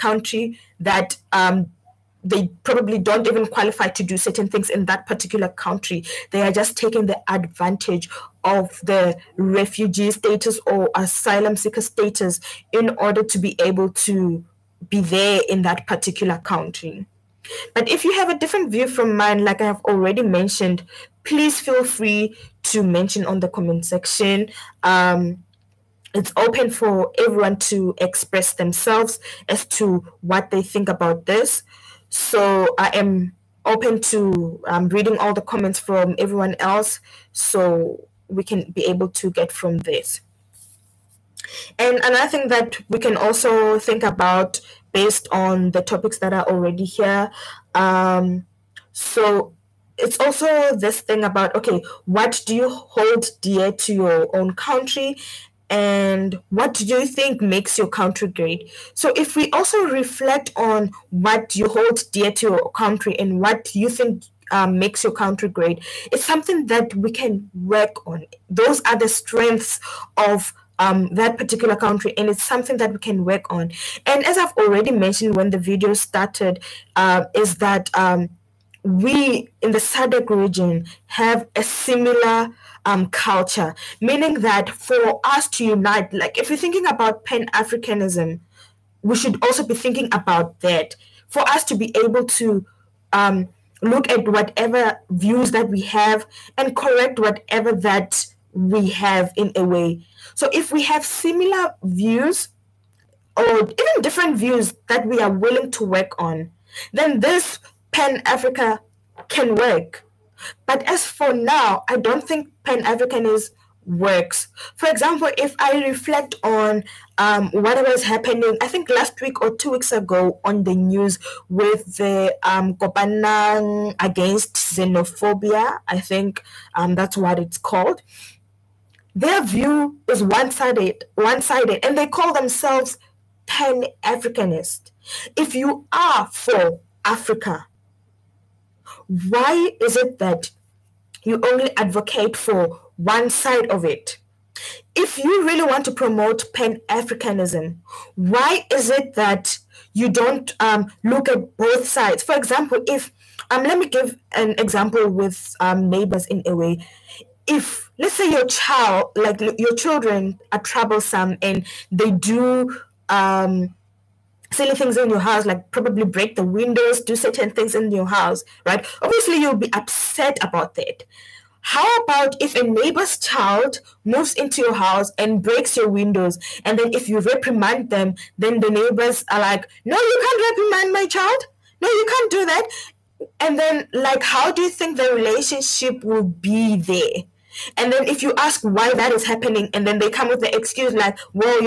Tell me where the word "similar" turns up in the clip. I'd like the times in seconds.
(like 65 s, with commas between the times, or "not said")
81 s, 101 s.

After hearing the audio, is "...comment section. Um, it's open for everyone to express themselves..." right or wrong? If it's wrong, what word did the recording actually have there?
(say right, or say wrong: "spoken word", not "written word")
right.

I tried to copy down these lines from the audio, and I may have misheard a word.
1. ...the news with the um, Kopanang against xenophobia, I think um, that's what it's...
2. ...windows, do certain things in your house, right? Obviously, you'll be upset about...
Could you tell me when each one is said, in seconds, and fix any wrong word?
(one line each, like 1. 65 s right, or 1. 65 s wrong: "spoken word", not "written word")
1. 120 s right
2. 166 s right.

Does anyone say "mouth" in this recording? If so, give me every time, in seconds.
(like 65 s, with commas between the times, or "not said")
not said.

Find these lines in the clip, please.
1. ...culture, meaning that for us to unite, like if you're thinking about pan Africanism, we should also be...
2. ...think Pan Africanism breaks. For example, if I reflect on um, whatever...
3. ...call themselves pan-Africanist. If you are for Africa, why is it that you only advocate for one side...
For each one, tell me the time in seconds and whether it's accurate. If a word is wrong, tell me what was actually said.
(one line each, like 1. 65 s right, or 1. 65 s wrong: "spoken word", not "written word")
1. 83 s right
2. 112 s wrong: "works", not "breaks"
3. 132 s right.